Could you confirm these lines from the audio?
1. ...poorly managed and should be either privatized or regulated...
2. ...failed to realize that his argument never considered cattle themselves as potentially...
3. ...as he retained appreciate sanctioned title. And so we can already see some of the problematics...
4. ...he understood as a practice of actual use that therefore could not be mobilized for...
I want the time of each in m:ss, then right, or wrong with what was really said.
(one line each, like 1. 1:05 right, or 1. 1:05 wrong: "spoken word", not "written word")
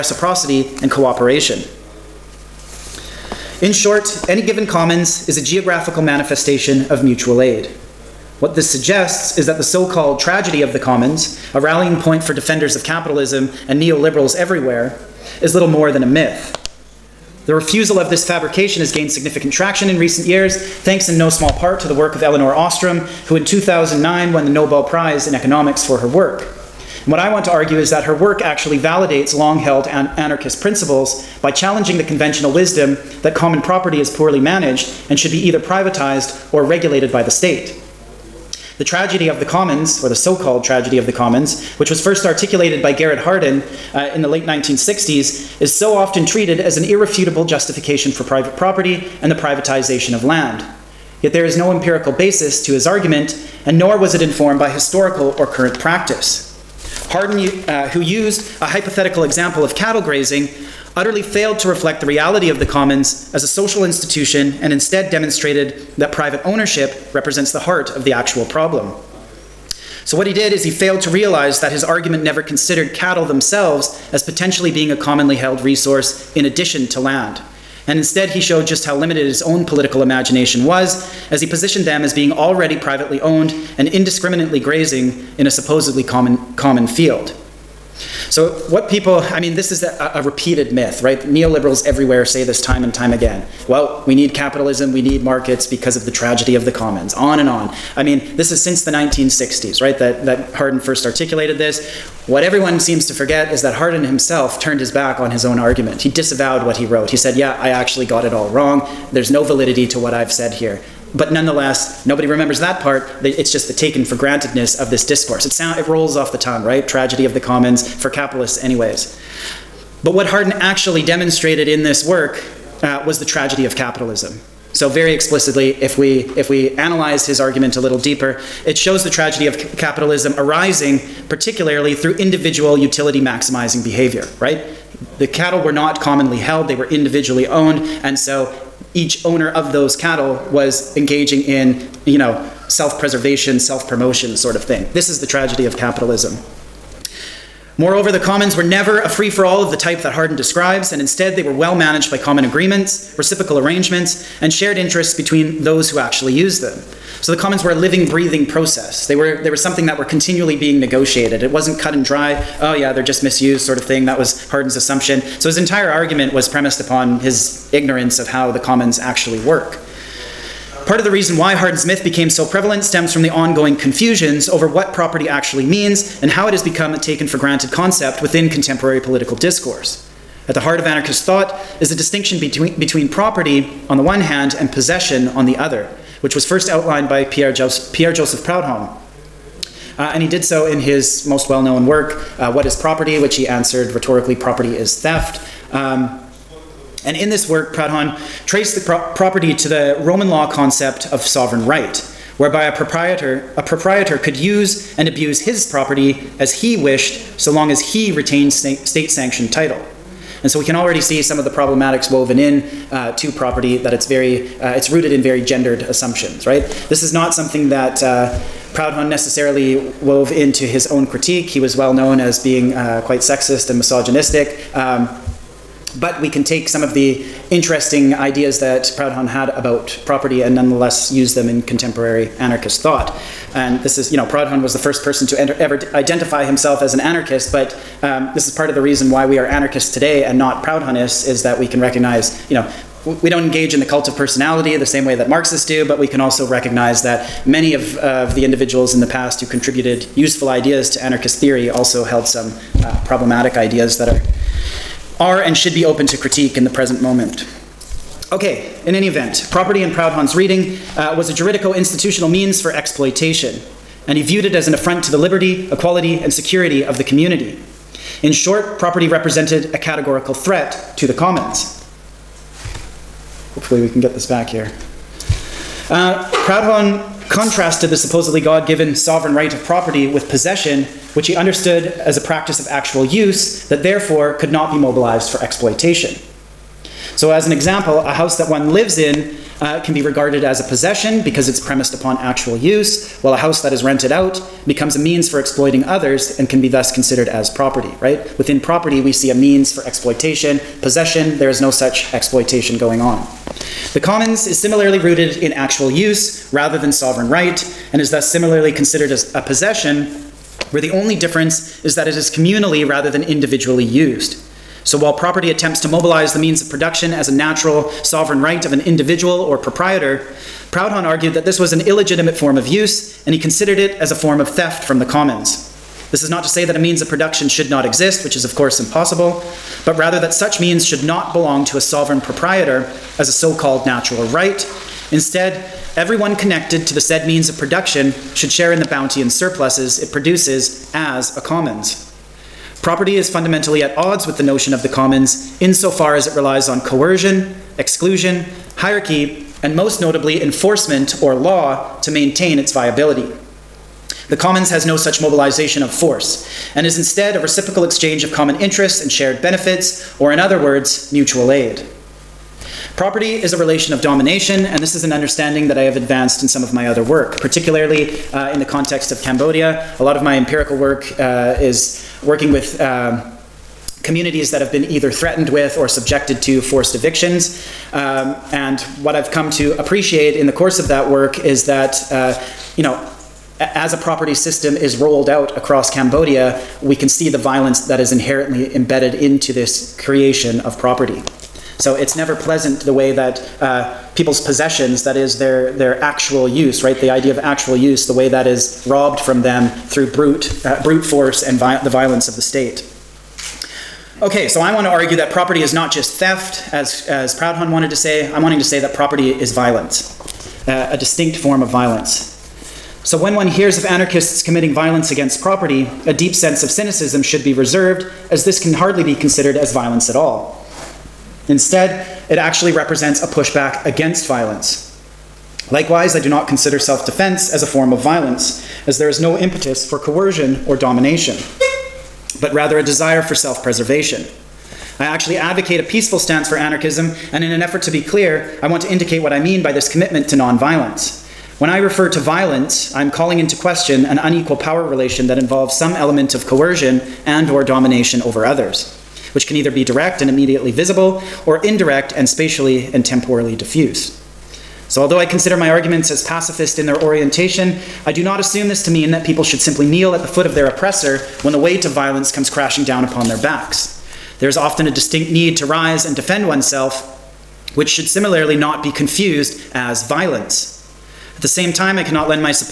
1. 0:34 right
2. 1:10 right
3. 3:27 wrong: "state", not "appreciate"
4. 4:41 right.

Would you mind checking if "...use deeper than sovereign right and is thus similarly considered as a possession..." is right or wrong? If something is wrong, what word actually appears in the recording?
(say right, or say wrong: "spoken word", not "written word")
wrong: "rather", not "deeper".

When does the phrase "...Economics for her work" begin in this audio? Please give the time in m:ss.
0:25.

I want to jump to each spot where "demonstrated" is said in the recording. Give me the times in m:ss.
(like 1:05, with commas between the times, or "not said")
1:05, 2:01.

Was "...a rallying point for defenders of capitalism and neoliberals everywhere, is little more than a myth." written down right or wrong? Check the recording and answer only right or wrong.
right.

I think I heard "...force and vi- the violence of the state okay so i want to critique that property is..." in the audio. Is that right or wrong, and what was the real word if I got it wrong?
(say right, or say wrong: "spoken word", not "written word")
wrong: "argue", not "critique".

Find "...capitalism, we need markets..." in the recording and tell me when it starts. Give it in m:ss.
1:34.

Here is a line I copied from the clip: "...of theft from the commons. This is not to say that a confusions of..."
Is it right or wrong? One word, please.
wrong.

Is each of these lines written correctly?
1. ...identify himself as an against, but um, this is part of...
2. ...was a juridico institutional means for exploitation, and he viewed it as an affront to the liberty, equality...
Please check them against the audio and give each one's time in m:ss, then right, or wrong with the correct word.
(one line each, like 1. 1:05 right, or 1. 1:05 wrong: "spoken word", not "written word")
1. 3:55 wrong: "anarchist", not "against"
2. 4:21 right.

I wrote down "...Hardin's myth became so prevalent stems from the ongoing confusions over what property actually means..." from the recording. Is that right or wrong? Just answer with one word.
right.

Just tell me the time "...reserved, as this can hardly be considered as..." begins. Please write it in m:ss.
6:57.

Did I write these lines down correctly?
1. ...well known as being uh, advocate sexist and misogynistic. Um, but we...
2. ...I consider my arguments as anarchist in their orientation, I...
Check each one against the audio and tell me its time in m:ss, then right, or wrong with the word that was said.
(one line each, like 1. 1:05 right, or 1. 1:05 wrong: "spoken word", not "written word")
1. 3:41 wrong: "quite", not "advocate"
2. 7:35 wrong: "pacifist", not "anarchist".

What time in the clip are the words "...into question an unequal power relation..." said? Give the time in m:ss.
7:23.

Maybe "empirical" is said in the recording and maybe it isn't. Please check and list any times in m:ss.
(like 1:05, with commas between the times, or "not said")
0:51, 6:10.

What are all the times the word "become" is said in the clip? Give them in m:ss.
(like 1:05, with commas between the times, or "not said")
2:56, 4:54.